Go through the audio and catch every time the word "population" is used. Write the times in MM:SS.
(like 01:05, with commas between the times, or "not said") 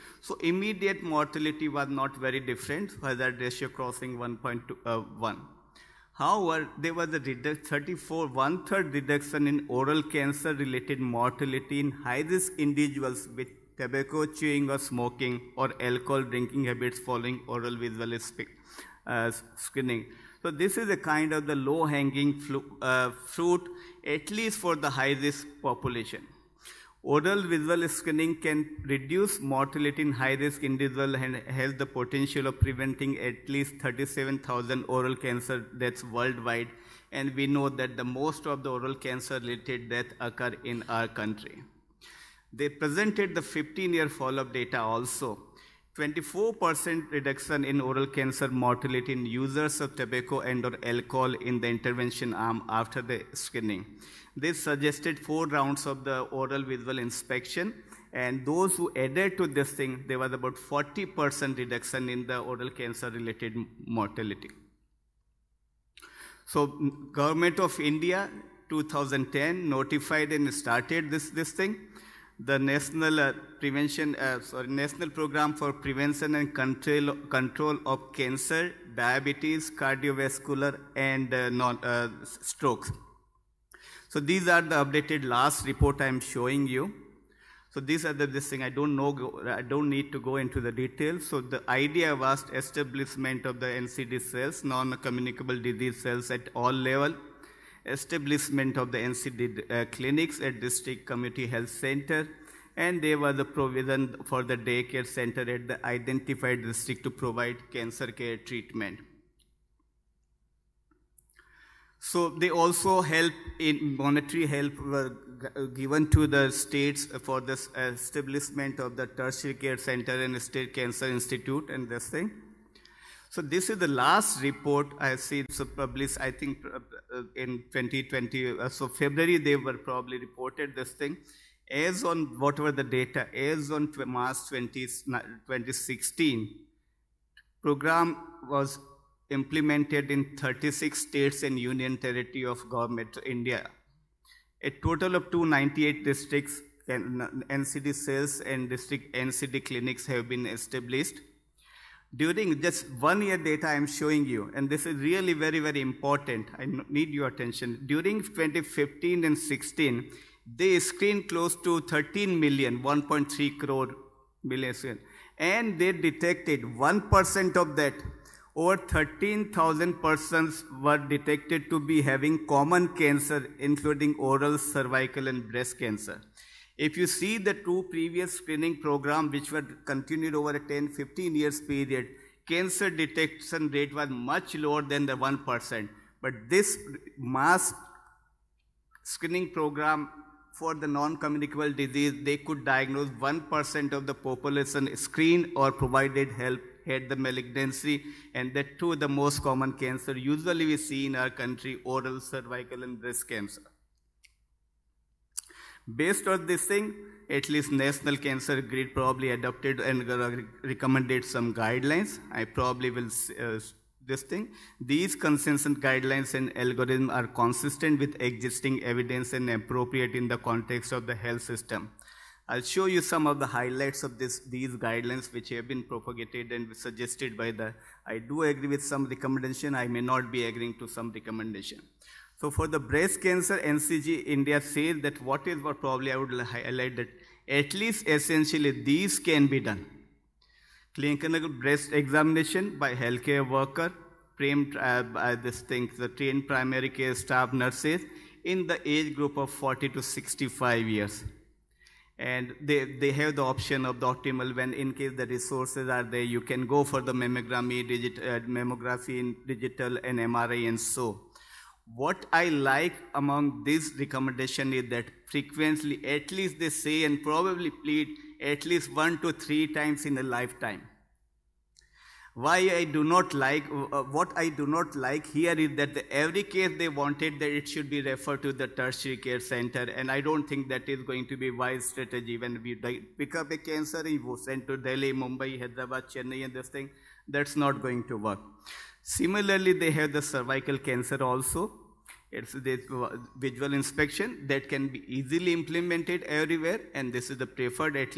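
00:25, 03:14.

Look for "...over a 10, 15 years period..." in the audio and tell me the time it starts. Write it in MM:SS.
03:00.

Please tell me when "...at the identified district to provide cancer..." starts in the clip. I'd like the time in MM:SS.
01:45.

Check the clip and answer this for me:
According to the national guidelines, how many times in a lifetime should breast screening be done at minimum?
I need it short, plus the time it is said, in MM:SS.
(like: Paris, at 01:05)
one to three times, at 04:28.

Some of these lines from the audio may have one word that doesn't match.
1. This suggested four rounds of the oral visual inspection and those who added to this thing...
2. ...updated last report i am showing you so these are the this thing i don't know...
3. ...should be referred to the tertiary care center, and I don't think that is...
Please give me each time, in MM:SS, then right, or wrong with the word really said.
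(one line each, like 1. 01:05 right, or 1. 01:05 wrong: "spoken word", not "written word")
1. 00:54 right
2. 01:24 right
3. 04:37 right.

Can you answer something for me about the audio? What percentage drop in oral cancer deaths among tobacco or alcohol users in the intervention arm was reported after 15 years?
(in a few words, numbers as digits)
24%.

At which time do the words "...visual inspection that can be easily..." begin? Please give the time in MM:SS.
04:53.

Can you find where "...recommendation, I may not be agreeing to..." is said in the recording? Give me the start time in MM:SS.
03:49.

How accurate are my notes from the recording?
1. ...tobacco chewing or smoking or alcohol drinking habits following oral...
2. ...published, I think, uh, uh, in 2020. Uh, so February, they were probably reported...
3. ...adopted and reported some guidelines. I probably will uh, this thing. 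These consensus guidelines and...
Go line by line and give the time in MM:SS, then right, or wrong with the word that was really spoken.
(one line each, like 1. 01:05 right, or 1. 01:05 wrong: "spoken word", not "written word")
1. 00:13 right
2. 02:05 right
3. 03:29 wrong: "recommended", not "reported".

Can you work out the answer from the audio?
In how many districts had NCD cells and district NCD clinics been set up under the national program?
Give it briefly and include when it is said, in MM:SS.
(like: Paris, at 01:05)
298, at 02:25.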